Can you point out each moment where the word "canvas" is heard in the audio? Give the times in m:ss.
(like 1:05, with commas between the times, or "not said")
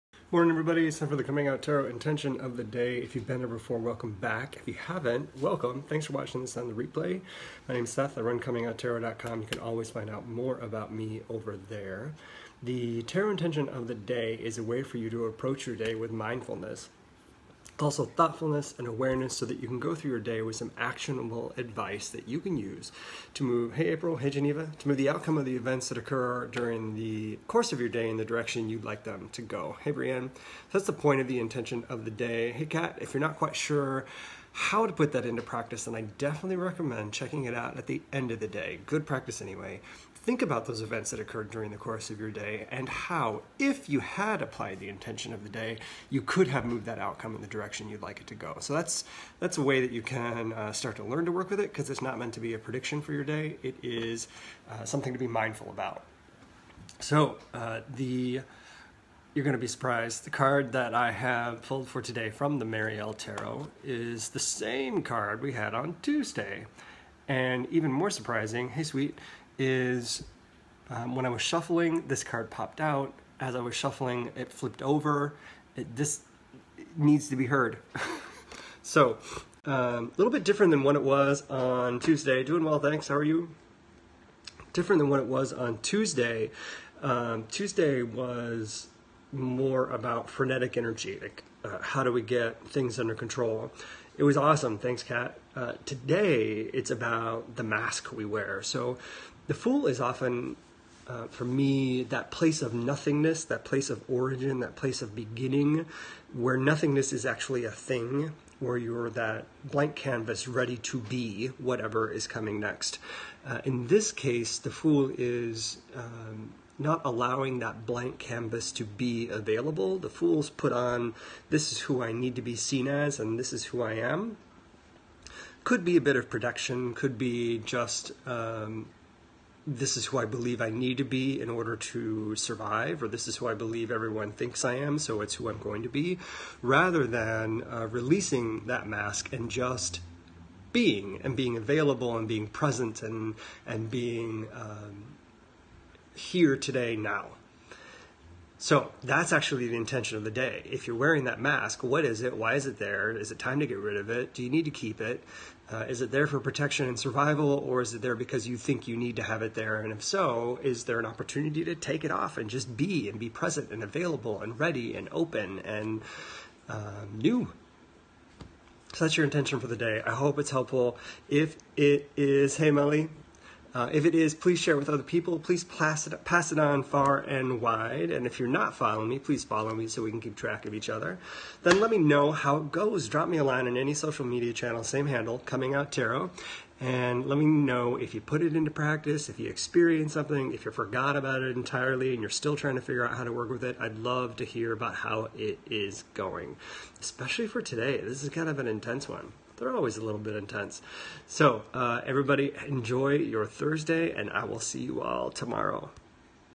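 1:49, 1:58.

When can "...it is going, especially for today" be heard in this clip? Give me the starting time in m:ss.
3:15.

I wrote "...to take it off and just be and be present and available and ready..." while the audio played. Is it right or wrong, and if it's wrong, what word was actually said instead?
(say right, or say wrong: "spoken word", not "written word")
right.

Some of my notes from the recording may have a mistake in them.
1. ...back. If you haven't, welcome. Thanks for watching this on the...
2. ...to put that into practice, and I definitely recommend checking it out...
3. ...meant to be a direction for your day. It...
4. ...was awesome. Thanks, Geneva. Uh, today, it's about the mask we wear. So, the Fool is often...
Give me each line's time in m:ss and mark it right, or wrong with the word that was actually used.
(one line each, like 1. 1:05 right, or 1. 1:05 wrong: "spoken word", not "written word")
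1. 0:04 right
2. 0:34 right
3. 0:52 wrong: "prediction", not "direction"
4. 1:34 wrong: "Kat", not "Geneva".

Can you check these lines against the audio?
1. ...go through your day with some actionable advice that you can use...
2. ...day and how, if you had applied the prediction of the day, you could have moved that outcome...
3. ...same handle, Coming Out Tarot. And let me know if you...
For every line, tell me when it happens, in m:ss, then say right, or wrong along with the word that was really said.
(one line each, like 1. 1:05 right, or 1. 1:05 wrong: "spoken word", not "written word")
1. 0:19 right
2. 0:42 wrong: "intention", not "prediction"
3. 3:04 right.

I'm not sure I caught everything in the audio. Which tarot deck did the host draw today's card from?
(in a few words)
Mary-El Tarot.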